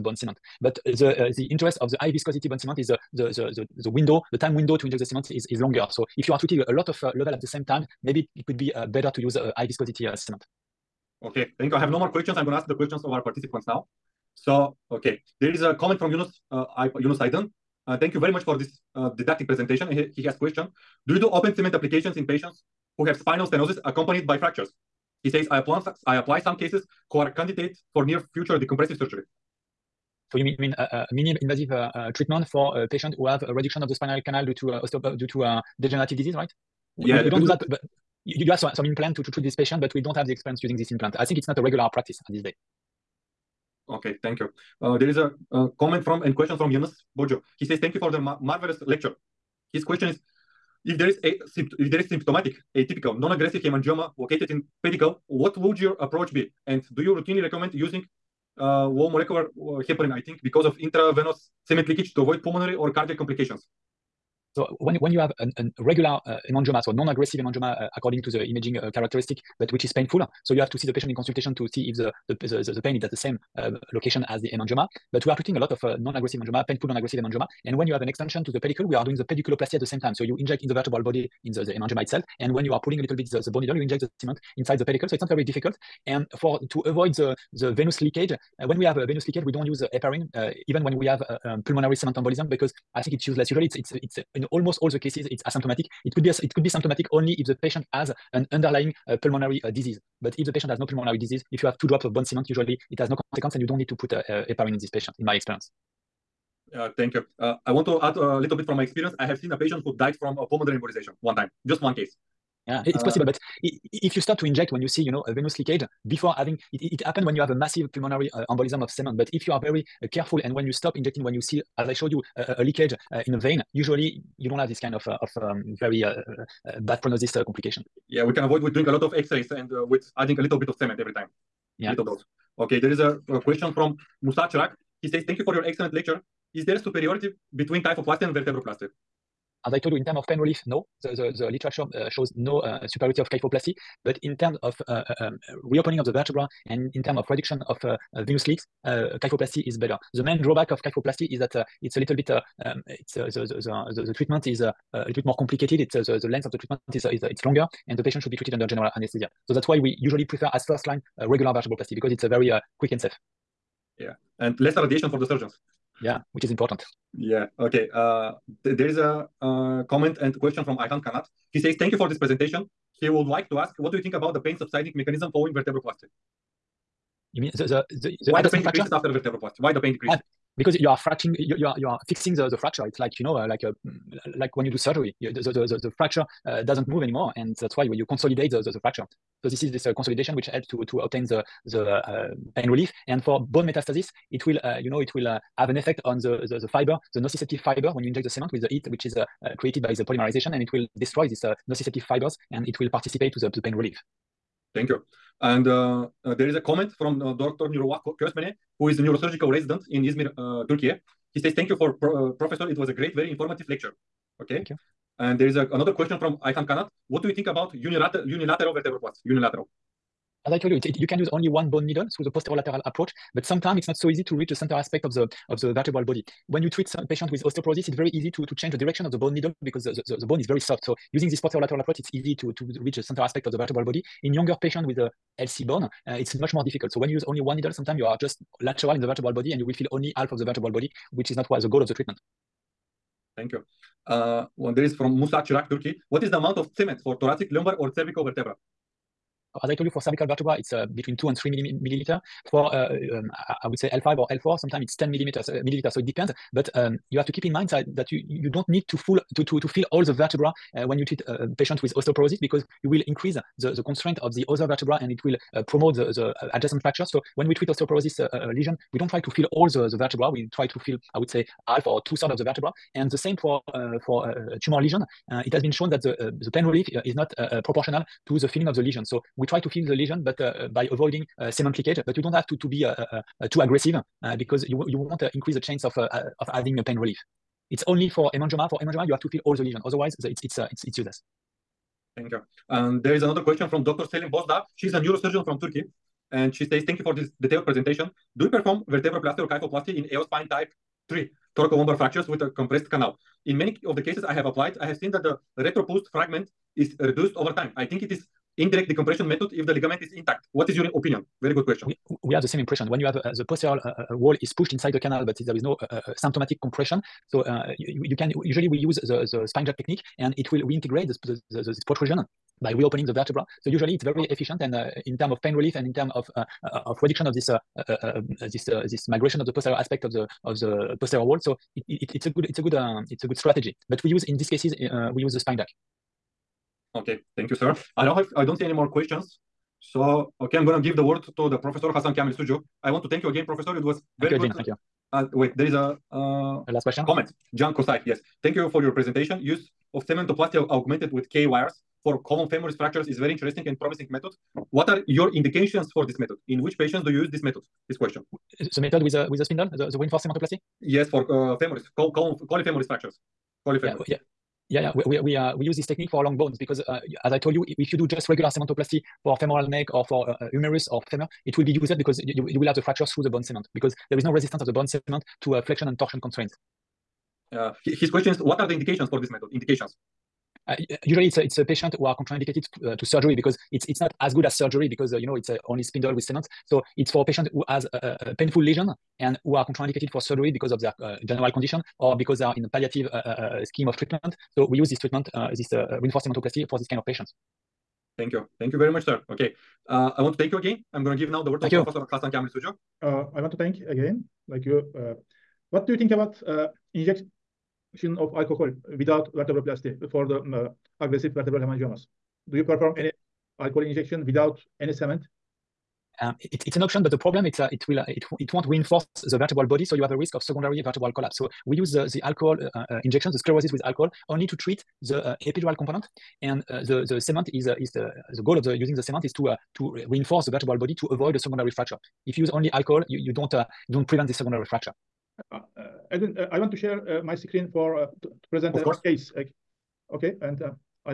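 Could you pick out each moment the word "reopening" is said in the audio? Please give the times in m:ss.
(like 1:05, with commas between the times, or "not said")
2:25, 5:22.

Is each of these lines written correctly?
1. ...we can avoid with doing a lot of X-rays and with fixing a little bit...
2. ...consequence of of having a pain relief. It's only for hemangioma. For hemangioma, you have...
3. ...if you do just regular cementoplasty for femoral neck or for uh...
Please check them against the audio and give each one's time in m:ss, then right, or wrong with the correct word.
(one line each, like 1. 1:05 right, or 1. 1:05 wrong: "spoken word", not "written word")
1. 2:08 wrong: "adding", not "fixing"
2. 4:45 wrong: "chance", not "consequence"
3. 6:07 right.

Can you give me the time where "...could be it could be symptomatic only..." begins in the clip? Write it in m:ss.
1:36.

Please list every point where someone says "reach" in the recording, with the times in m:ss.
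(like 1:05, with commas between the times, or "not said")
3:44, 3:52.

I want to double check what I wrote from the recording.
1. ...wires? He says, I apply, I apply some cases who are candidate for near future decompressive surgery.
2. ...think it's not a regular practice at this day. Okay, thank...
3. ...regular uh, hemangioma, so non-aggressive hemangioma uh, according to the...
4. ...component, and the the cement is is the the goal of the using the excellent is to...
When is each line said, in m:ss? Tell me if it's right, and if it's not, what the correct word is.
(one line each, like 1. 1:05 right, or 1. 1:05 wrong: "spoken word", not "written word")
1. 0:24 wrong: "fractures", not "wires"
2. 0:41 right
3. 1:05 right
4. 7:05 wrong: "cement", not "excellent".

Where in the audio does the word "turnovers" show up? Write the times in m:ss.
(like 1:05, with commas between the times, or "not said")
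not said.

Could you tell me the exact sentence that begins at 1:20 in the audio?
So you inject in the vertebral body in the, the hemangioma itself.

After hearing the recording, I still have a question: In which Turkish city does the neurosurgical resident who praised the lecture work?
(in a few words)
Izmir.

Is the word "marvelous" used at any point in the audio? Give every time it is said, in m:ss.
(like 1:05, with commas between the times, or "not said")
0:48.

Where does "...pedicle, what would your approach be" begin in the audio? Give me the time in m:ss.
0:54.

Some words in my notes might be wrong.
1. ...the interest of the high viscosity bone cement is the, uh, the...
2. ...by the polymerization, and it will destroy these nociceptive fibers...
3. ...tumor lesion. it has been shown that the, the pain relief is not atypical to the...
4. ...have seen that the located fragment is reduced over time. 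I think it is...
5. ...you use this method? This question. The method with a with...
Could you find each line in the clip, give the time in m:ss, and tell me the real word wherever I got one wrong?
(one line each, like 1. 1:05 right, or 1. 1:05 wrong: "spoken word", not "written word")
1. 0:01 right
2. 3:19 right
3. 4:34 wrong: "proportional", not "atypical"
4. 5:04 wrong: "retropulsed", not "located"
5. 5:57 right.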